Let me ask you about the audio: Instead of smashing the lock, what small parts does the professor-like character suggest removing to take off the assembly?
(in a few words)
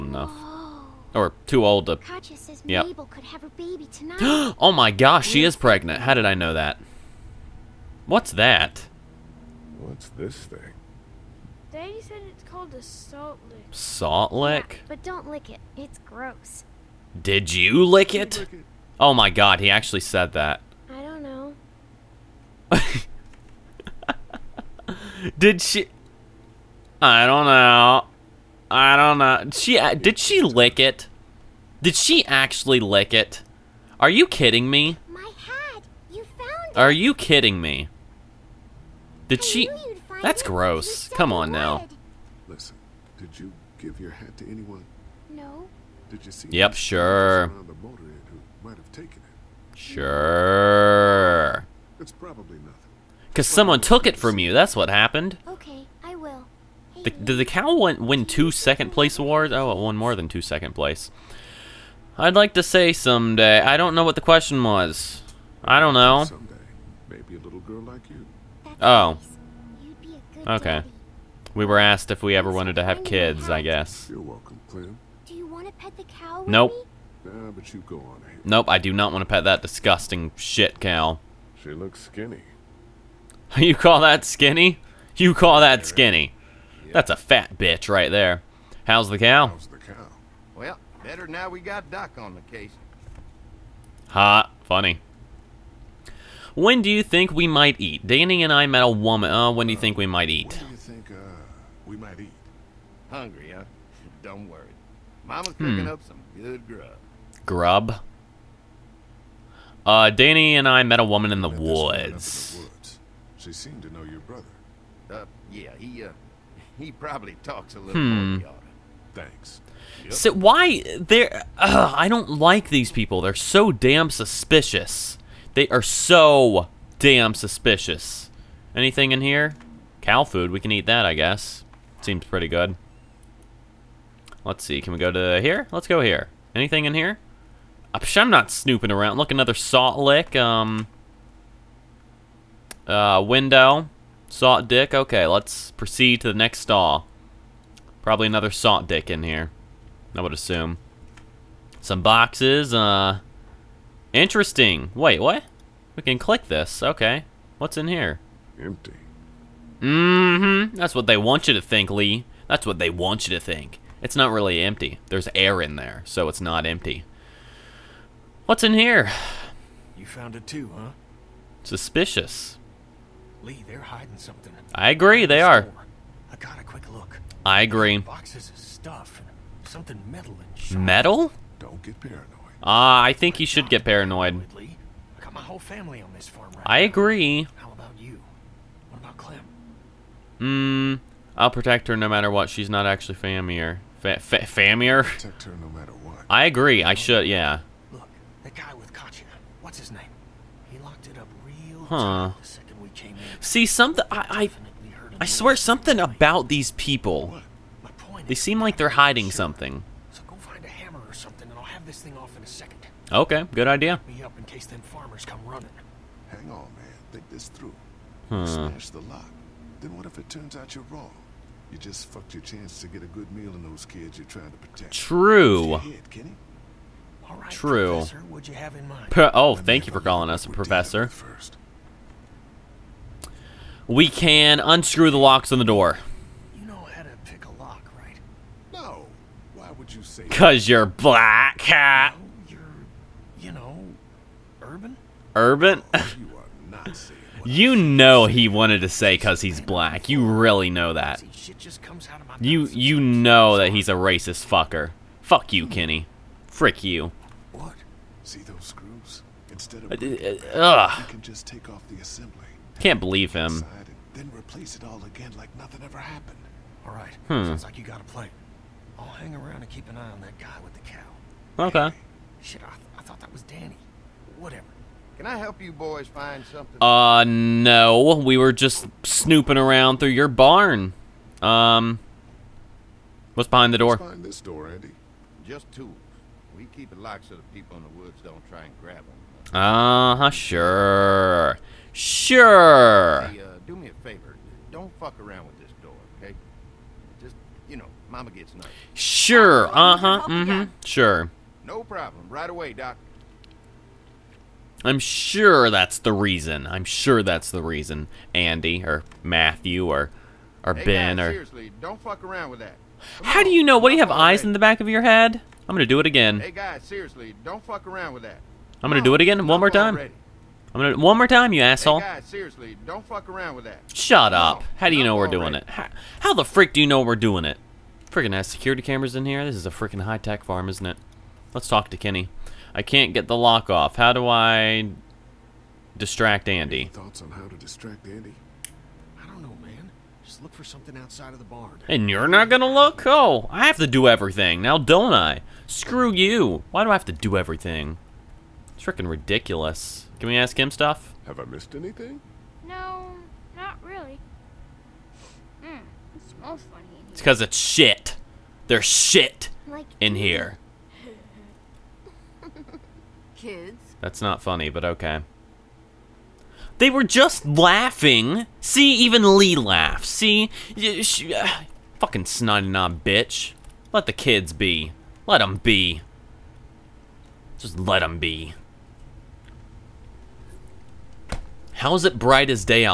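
Screws.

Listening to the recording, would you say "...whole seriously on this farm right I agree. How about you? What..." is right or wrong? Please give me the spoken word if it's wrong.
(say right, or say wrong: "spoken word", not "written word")
wrong: "family", not "seriously".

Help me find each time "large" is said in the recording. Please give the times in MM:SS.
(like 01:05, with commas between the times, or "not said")
not said.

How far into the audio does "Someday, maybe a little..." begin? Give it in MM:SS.
01:06.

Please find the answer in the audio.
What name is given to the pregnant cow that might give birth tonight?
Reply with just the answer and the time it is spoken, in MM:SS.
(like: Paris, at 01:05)
Mabel, at 00:02.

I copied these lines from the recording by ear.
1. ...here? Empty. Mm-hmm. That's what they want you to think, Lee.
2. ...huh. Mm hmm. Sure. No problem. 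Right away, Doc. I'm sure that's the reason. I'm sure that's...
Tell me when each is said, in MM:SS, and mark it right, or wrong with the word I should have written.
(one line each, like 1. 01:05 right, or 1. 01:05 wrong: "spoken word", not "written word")
1. 02:37 right
2. 04:59 right.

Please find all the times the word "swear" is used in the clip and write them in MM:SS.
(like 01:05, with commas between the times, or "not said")
03:25.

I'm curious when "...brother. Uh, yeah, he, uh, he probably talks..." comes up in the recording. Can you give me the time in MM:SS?
01:54.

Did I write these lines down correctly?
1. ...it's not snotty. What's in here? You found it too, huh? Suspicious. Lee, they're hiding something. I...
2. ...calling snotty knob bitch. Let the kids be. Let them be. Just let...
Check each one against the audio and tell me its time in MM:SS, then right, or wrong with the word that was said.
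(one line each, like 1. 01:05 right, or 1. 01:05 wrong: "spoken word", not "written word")
1. 02:46 wrong: "empty", not "snotty"
2. 06:11 wrong: "fucking", not "calling".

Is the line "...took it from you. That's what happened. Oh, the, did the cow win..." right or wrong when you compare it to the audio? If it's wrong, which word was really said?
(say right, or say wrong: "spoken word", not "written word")
right.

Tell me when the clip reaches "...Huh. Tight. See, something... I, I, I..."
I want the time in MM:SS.
03:21.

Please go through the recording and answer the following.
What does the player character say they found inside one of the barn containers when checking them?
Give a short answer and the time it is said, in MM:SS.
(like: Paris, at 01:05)
Cow food, at 02:10.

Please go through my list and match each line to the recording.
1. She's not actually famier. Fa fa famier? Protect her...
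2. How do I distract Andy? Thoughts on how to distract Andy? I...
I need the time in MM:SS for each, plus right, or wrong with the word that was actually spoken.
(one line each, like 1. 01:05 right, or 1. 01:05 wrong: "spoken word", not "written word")
1. 03:12 right
2. 05:33 right.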